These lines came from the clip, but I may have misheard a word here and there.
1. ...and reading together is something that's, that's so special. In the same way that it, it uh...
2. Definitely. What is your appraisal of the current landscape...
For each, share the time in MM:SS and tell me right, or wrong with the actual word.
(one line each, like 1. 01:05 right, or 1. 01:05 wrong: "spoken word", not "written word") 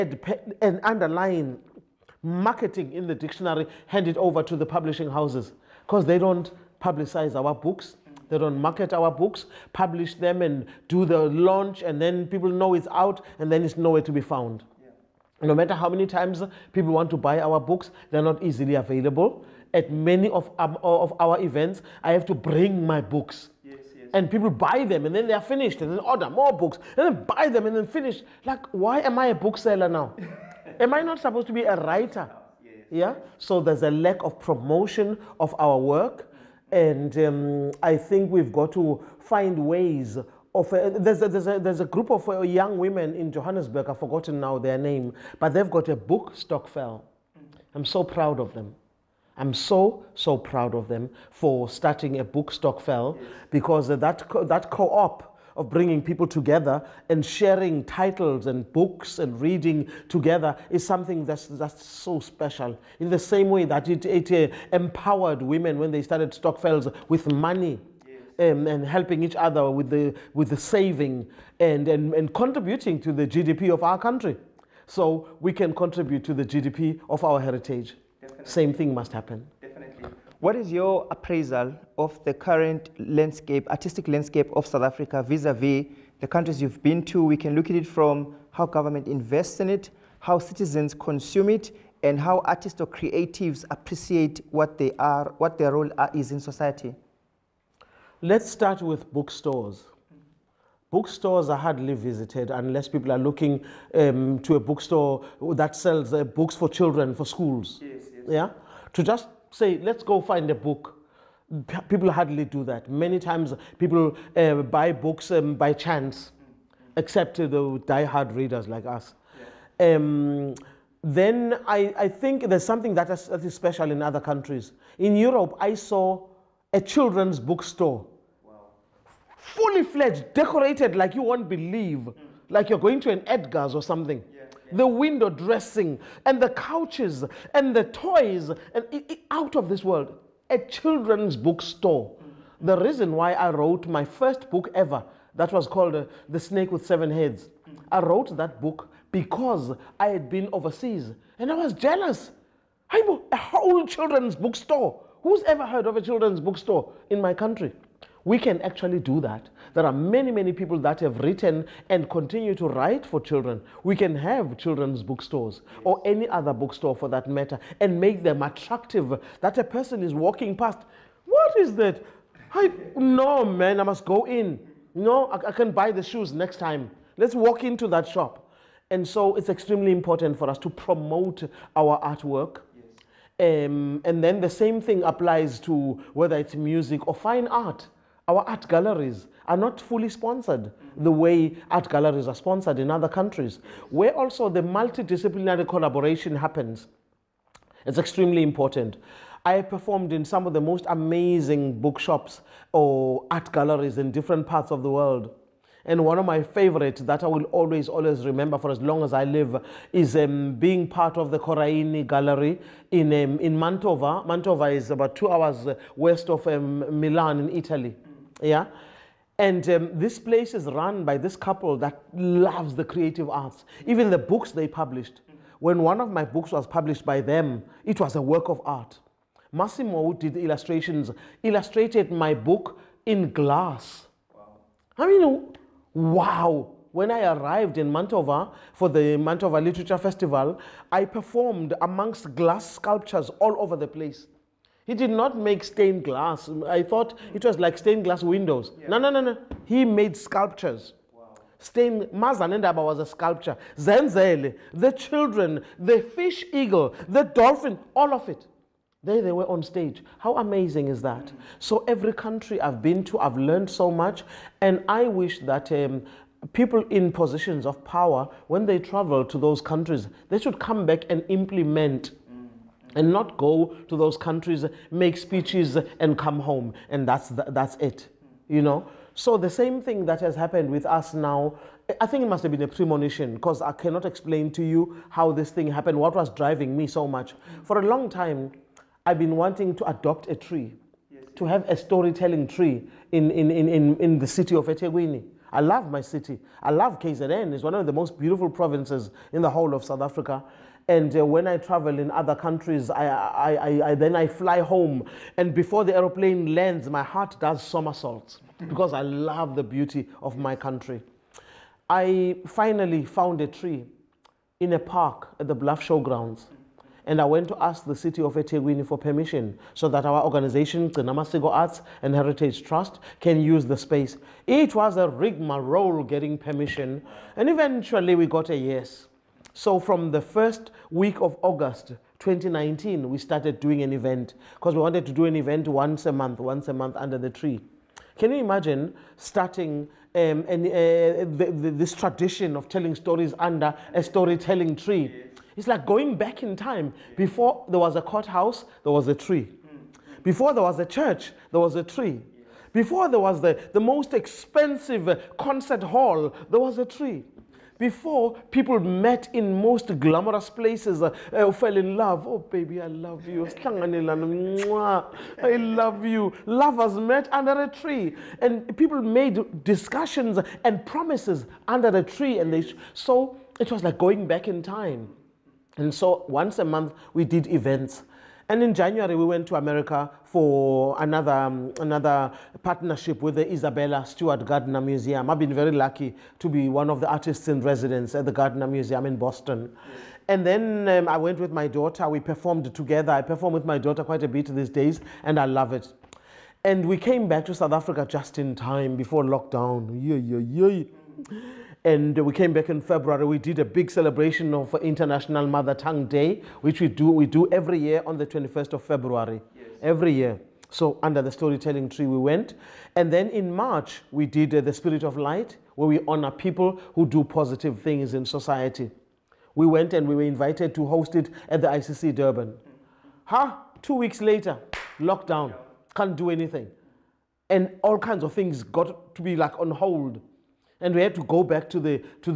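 1. 00:59 right
2. 01:19 right.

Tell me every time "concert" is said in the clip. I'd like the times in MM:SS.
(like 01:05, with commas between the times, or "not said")
05:55.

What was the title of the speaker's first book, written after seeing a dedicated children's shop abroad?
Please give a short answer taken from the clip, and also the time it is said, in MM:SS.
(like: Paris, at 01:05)
The Snake with Seven Heads, at 02:26.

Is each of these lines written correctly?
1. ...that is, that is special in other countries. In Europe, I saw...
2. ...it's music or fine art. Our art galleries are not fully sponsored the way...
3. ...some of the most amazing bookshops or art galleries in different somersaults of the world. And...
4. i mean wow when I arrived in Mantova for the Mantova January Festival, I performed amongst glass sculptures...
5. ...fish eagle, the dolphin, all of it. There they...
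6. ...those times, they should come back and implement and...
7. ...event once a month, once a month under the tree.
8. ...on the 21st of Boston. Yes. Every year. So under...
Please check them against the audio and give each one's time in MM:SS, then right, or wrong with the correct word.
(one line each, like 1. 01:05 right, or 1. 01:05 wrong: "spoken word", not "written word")
1. 02:02 right
2. 03:06 right
3. 03:20 wrong: "parts", not "somersaults"
4. 03:54 wrong: "Literature", not "January"
5. 04:16 right
6. 04:29 wrong: "countries", not "times"
7. 05:35 right
8. 06:48 wrong: "February", not "Boston".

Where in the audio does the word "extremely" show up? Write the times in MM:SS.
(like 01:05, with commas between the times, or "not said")
02:59, 03:17.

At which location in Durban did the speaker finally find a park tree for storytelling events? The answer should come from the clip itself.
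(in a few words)
Bluff Showgrounds.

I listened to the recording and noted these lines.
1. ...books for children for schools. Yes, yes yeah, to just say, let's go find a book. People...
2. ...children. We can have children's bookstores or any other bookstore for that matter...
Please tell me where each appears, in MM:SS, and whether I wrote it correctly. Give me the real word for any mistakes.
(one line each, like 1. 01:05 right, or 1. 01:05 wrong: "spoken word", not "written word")
1. 01:46 right
2. 02:43 right.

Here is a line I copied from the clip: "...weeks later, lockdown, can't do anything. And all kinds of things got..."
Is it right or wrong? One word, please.
right.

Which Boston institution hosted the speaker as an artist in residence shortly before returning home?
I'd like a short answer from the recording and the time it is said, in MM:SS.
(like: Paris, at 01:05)
Isabella Stewart Gardner Museum, at 06:23.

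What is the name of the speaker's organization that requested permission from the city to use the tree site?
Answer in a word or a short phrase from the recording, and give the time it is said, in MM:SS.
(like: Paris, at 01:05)
Gcinamasiko Arts and Heritage Trust, at 05:20.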